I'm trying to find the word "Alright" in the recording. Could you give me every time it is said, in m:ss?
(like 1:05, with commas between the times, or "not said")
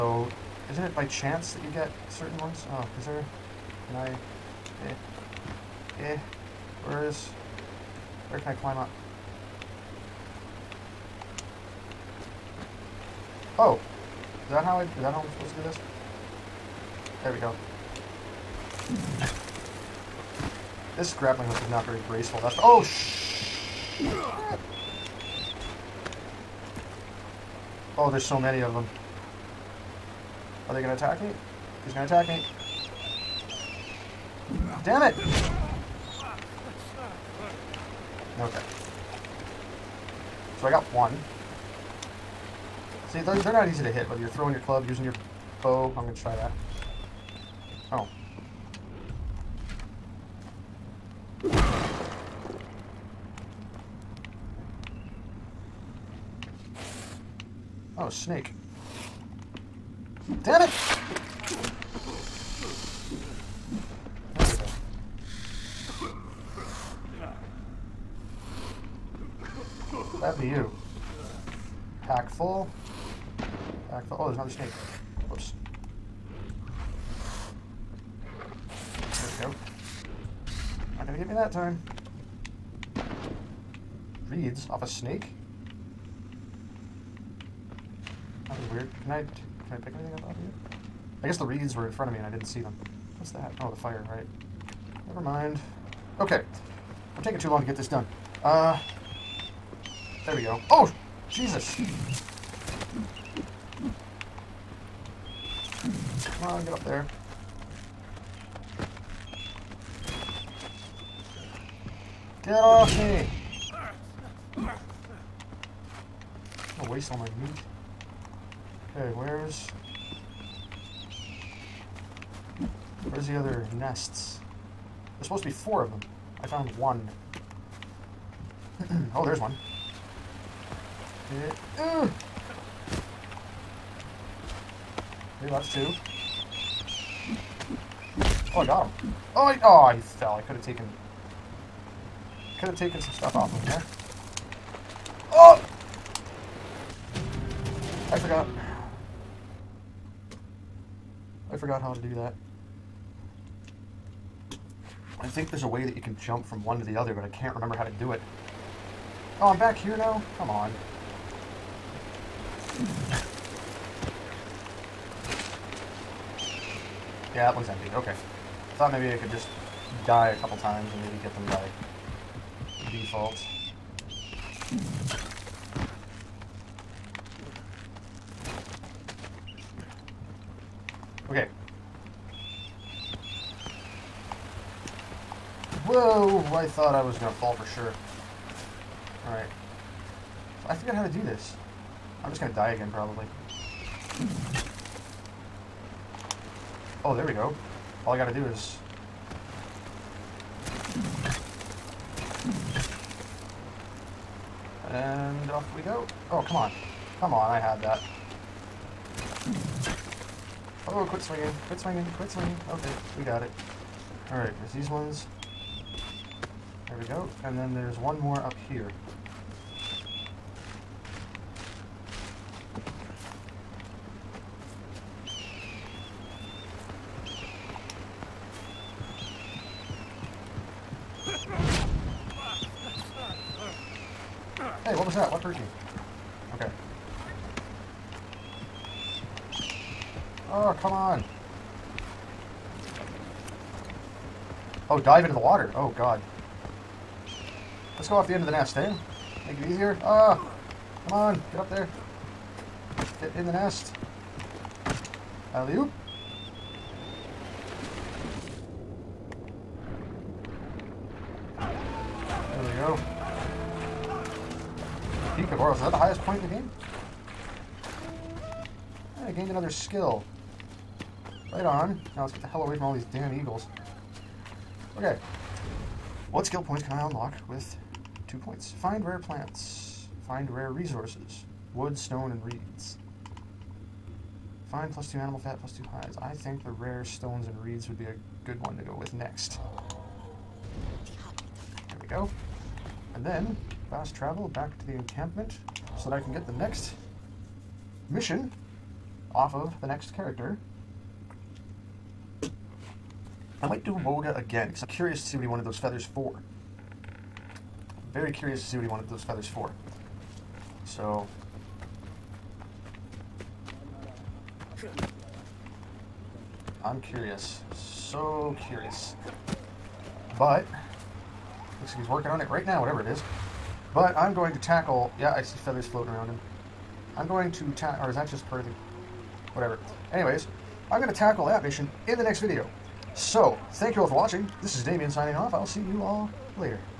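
3:09, 3:34.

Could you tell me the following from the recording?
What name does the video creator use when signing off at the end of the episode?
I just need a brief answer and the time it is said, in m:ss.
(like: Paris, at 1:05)
Damian, at 5:34.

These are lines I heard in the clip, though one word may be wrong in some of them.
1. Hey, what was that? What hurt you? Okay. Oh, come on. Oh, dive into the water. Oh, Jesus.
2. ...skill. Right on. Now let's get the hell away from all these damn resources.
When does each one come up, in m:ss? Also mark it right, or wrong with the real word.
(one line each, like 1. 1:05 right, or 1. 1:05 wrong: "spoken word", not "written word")
1. 3:54 wrong: "God", not "Jesus"
2. 4:29 wrong: "eagles", not "resources".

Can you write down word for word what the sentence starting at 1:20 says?
Not gonna get me that time.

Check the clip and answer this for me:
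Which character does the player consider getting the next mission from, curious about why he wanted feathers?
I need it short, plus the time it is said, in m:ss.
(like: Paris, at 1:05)
Volga, at 5:04.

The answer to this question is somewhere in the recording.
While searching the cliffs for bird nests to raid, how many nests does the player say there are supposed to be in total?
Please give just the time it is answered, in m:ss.
2:05.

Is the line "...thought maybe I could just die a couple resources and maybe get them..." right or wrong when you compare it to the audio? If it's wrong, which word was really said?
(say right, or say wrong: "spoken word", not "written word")
wrong: "times", not "resources".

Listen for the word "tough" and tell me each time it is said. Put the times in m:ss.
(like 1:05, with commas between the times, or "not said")
not said.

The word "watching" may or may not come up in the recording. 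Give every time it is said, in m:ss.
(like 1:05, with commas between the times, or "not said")
5:34.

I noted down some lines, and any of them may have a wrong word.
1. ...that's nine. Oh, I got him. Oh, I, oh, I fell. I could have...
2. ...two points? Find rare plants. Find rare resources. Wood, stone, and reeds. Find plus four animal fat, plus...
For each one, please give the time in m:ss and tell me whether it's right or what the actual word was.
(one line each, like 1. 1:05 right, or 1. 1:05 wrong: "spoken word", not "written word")
1. 2:15 wrong: "two", not "nine"
2. 4:38 wrong: "two", not "four".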